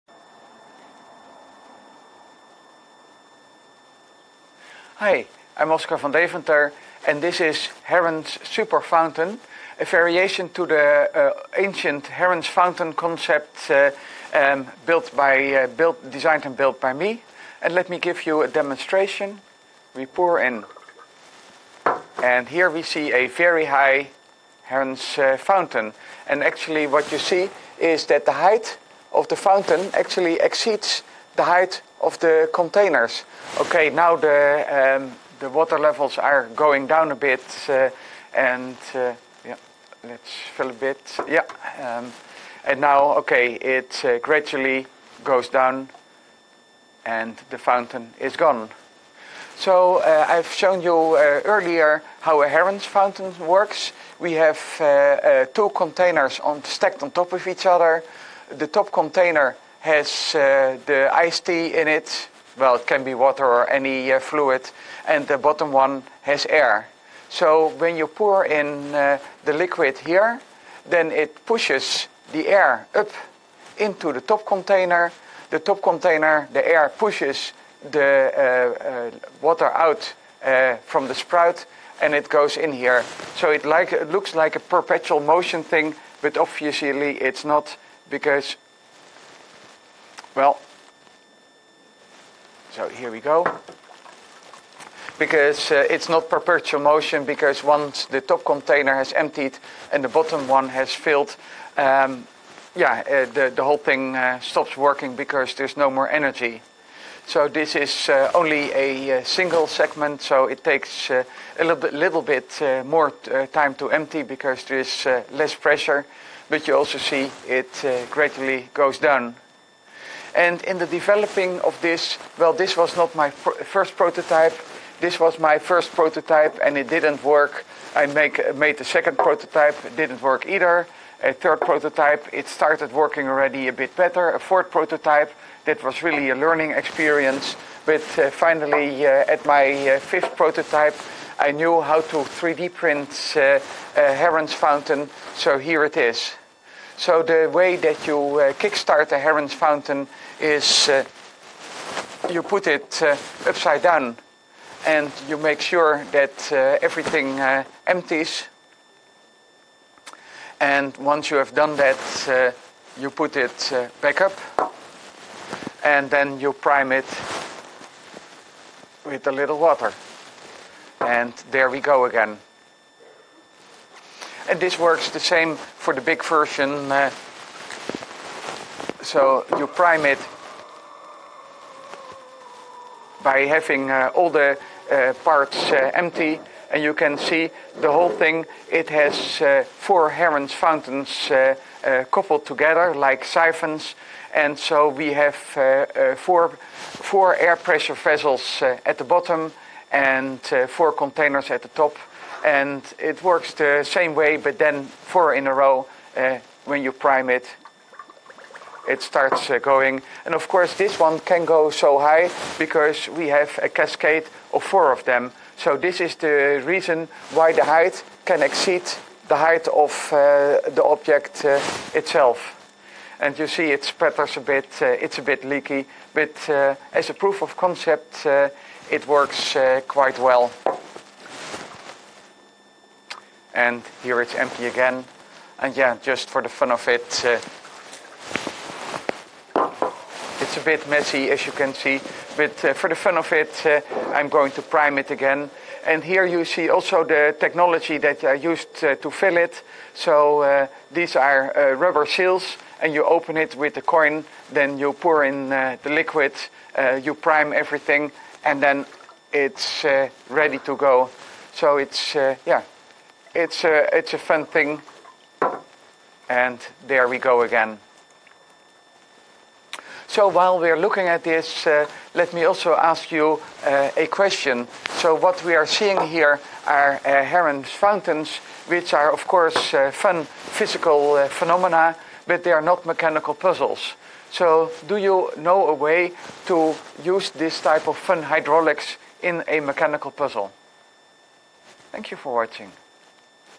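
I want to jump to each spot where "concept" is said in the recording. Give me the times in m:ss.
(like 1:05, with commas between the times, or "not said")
0:12, 3:47.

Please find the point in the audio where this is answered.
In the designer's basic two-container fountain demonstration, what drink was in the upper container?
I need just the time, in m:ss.
1:01.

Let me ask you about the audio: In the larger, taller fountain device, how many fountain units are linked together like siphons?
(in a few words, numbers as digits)
4.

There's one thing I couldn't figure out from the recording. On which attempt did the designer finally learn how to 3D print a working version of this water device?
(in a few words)
Fifth prototype.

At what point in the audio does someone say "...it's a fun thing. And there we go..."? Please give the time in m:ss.
4:23.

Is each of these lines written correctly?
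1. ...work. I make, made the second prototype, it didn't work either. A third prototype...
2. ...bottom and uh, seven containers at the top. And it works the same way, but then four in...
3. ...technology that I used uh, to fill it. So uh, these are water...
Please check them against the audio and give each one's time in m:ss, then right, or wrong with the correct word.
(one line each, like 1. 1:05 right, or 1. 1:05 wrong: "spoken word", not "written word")
1. 2:07 right
2. 3:19 wrong: "four", not "seven"
3. 4:07 wrong: "rubber", not "water".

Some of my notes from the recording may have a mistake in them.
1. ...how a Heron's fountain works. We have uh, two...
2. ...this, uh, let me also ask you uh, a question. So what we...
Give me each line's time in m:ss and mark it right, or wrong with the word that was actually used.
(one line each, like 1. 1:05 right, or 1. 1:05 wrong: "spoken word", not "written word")
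1. 0:52 right
2. 4:31 right.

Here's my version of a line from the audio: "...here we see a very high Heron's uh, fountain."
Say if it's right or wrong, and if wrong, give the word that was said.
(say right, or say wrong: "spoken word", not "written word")
right.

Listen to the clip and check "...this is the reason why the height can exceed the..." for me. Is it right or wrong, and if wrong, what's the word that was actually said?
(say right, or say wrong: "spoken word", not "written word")
right.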